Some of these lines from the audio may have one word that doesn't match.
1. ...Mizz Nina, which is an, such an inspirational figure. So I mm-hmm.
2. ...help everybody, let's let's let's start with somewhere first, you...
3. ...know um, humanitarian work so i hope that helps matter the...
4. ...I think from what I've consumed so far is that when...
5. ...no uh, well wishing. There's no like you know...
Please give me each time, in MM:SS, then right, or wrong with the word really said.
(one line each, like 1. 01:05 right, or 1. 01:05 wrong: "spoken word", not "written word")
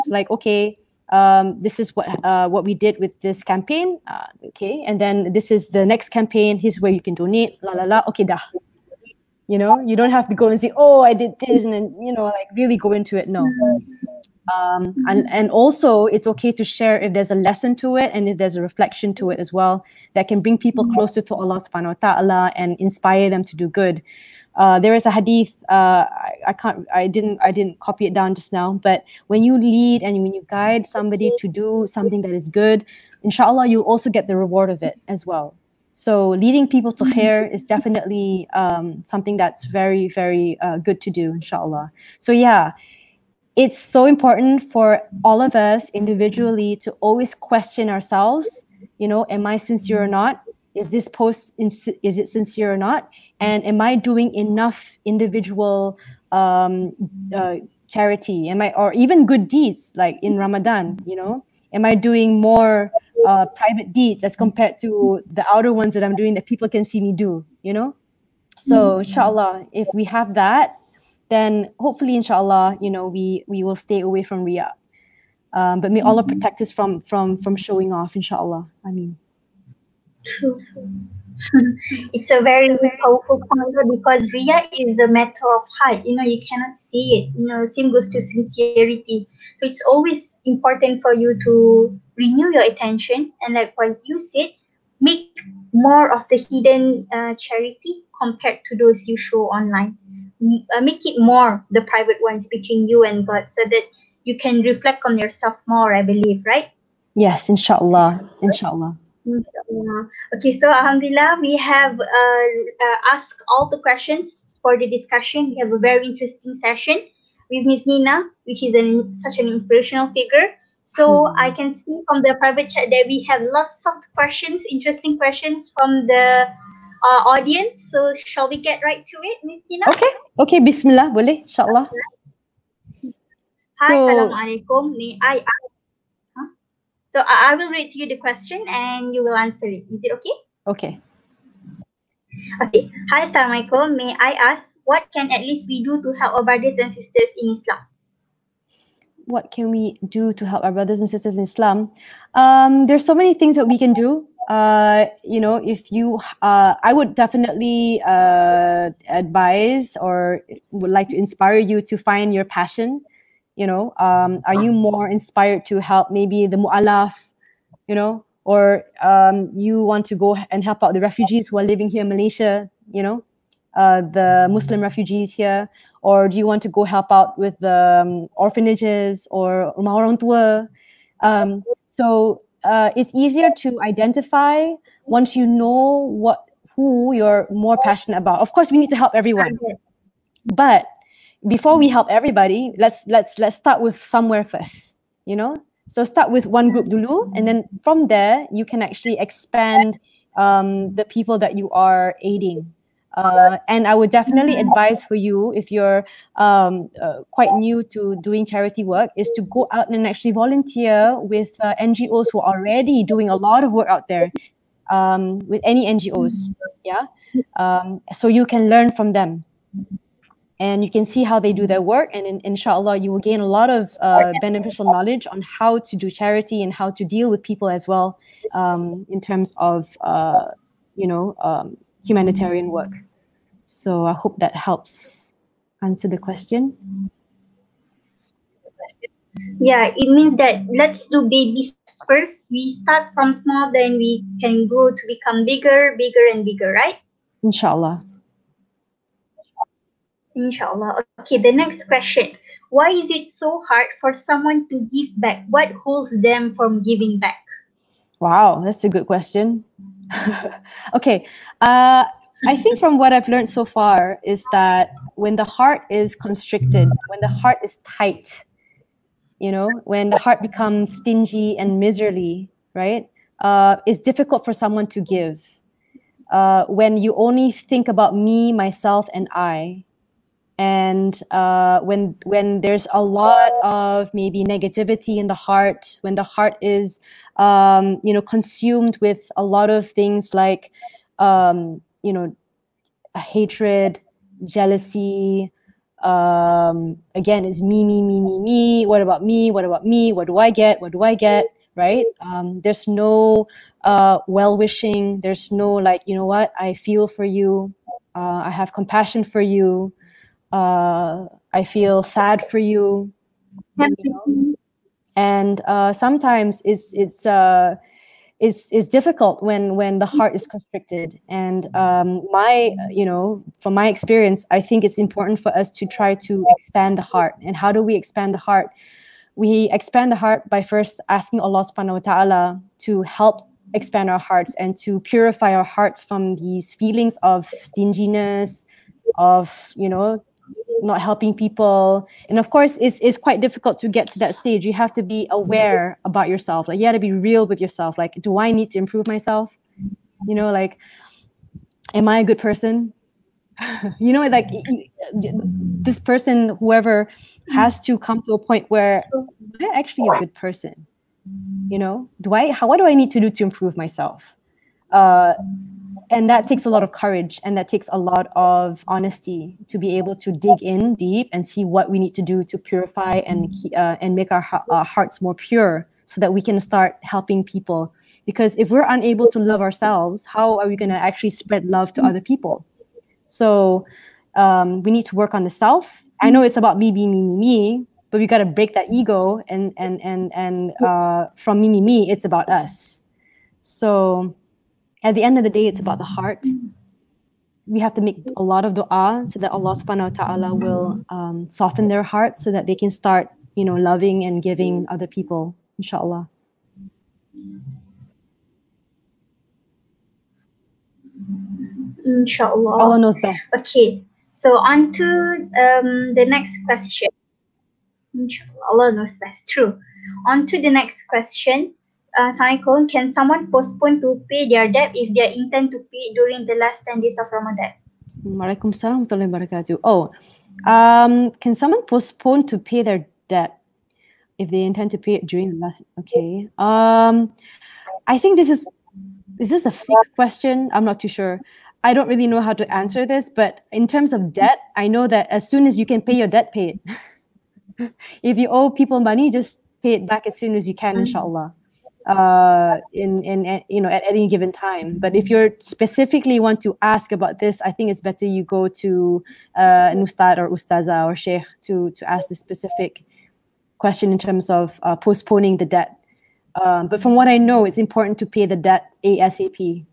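1. 01:57 right
2. 03:11 right
3. 03:51 wrong: "answer", not "matter"
4. 04:22 wrong: "learned", not "consumed"
5. 05:02 right.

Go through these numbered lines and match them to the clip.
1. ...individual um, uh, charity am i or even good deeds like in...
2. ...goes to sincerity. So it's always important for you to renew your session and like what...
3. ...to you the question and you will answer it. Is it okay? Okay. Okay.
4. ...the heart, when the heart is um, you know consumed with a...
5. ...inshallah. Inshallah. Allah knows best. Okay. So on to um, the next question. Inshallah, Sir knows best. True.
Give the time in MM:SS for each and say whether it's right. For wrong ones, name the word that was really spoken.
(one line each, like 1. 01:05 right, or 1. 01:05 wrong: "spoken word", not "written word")
1. 00:55 right
2. 01:27 wrong: "attention", not "session"
3. 02:17 right
4. 04:45 right
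5. 06:45 wrong: "Allah", not "Sir".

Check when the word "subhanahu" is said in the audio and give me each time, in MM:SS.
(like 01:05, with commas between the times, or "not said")
00:21, 05:31, 06:39.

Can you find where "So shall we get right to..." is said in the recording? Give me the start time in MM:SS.
02:07.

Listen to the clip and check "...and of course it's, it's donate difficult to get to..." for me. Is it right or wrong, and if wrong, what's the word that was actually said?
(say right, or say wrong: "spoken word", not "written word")
wrong: "quite", not "donate".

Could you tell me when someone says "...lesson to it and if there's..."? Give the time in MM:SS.
00:17.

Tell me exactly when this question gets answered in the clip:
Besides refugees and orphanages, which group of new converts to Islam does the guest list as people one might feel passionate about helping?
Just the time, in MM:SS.
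02:46.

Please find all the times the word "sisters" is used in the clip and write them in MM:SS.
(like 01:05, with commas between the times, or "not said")
02:26, 02:31.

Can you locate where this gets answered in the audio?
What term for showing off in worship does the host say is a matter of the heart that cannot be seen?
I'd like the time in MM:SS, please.
01:24.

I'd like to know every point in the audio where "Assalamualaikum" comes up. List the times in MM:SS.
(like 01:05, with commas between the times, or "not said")
02:13, 07:02.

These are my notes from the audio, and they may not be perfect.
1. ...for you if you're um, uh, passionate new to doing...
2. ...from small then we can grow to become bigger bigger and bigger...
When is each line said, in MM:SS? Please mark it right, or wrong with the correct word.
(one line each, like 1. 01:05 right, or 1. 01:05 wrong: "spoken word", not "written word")
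1. 03:25 wrong: "quite", not "passionate"
2. 04:03 right.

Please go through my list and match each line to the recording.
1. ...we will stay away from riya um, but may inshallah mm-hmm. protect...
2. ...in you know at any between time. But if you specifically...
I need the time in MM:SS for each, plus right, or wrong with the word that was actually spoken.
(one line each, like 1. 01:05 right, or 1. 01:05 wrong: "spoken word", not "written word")
1. 01:13 wrong: "allah", not "inshallah"
2. 07:33 wrong: "given", not "between".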